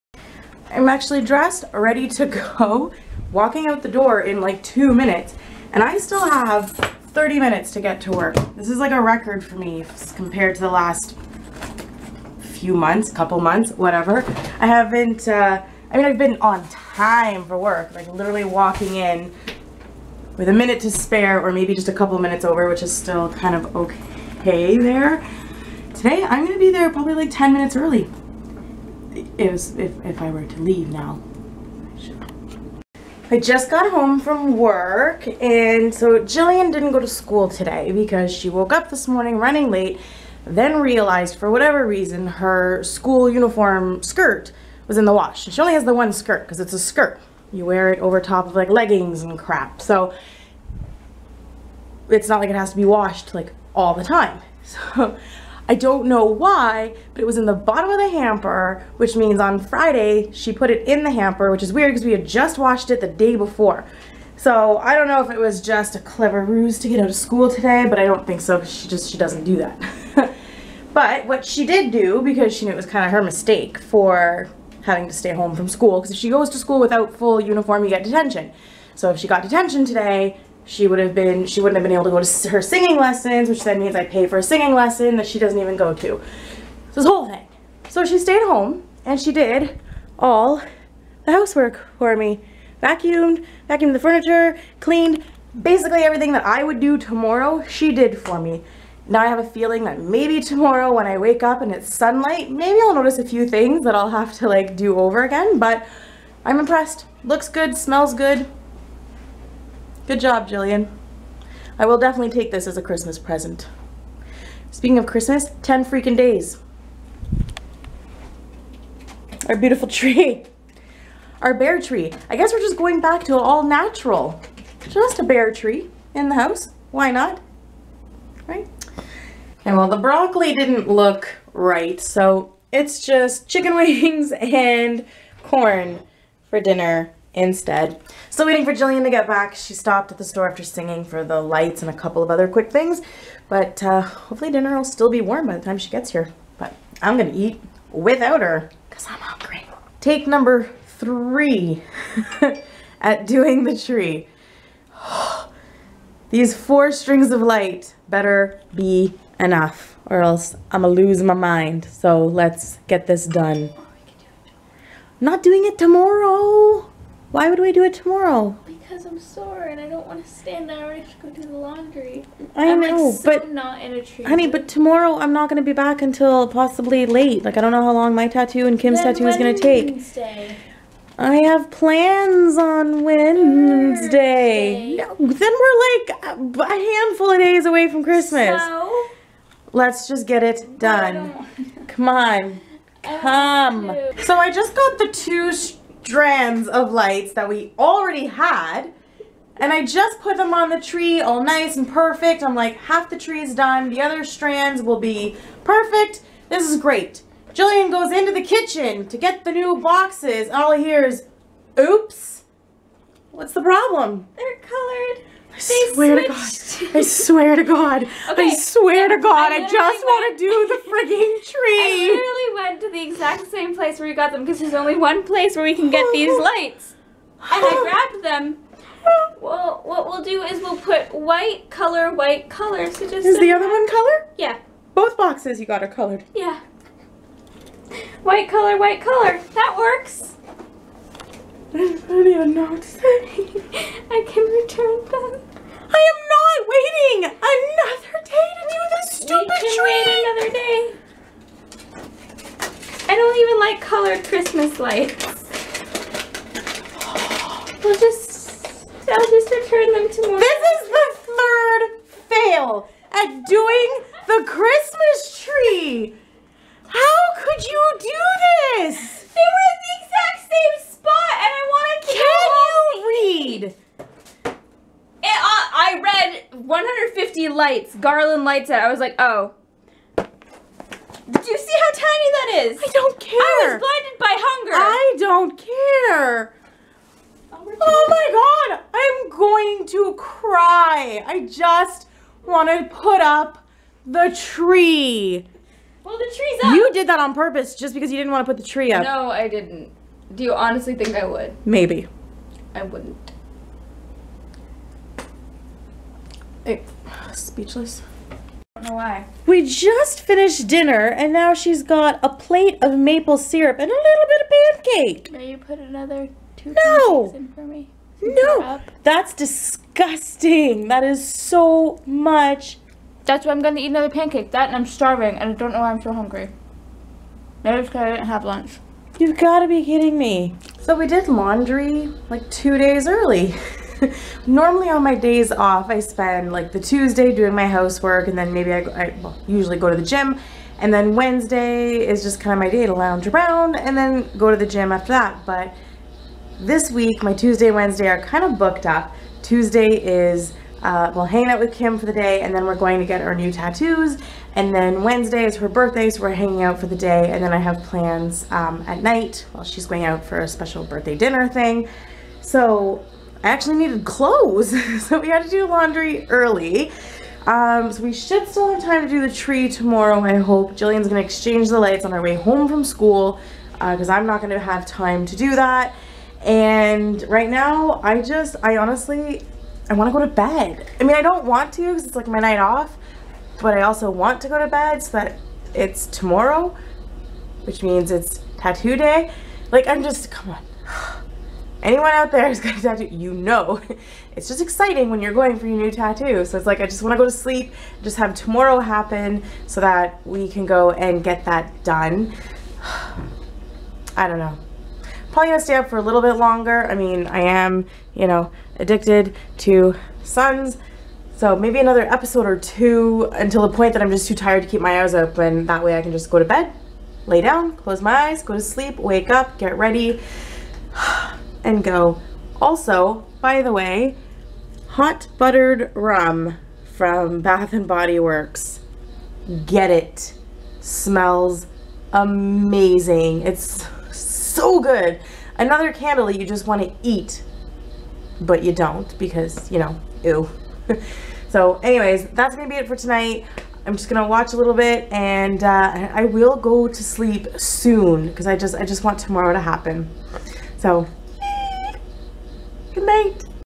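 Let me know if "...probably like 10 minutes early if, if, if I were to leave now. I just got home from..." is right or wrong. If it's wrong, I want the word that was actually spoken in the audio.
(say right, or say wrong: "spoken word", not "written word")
right.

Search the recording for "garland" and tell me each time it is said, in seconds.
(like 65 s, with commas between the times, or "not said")
277 s.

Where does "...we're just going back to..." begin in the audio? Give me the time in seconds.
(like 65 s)
122 s.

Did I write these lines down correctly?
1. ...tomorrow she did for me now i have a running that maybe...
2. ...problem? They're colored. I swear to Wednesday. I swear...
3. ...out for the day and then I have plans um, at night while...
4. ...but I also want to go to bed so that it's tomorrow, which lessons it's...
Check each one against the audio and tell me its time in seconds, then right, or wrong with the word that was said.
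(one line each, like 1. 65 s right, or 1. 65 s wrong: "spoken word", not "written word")
1. 96 s wrong: "feeling", not "running"
2. 213 s wrong: "God", not "Wednesday"
3. 356 s right
4. 383 s wrong: "means", not "lessons".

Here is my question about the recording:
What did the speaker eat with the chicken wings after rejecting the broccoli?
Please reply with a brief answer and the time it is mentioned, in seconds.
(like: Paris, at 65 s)
corn, at 135 s.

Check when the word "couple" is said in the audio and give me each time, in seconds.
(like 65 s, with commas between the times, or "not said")
13 s, 21 s, 141 s.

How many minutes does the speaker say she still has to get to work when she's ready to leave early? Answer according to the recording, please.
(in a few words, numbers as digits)
30.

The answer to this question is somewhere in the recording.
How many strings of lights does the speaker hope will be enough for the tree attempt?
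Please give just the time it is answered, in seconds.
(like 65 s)
156 s.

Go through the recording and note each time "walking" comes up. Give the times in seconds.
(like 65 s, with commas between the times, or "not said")
3 s, 18 s.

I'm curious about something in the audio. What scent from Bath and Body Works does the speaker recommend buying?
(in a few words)
hot buttered rum.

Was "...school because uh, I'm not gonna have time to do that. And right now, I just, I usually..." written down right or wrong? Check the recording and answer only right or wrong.
wrong.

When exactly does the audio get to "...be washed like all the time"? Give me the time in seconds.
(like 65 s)
52 s.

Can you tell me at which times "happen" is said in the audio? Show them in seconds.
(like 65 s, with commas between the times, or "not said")
398 s, 449 s.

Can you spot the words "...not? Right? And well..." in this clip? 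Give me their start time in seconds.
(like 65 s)
127 s.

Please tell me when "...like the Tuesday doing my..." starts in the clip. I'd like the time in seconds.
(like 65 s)
336 s.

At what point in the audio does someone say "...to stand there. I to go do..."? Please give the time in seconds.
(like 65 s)
170 s.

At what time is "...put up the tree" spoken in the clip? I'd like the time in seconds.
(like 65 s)
292 s.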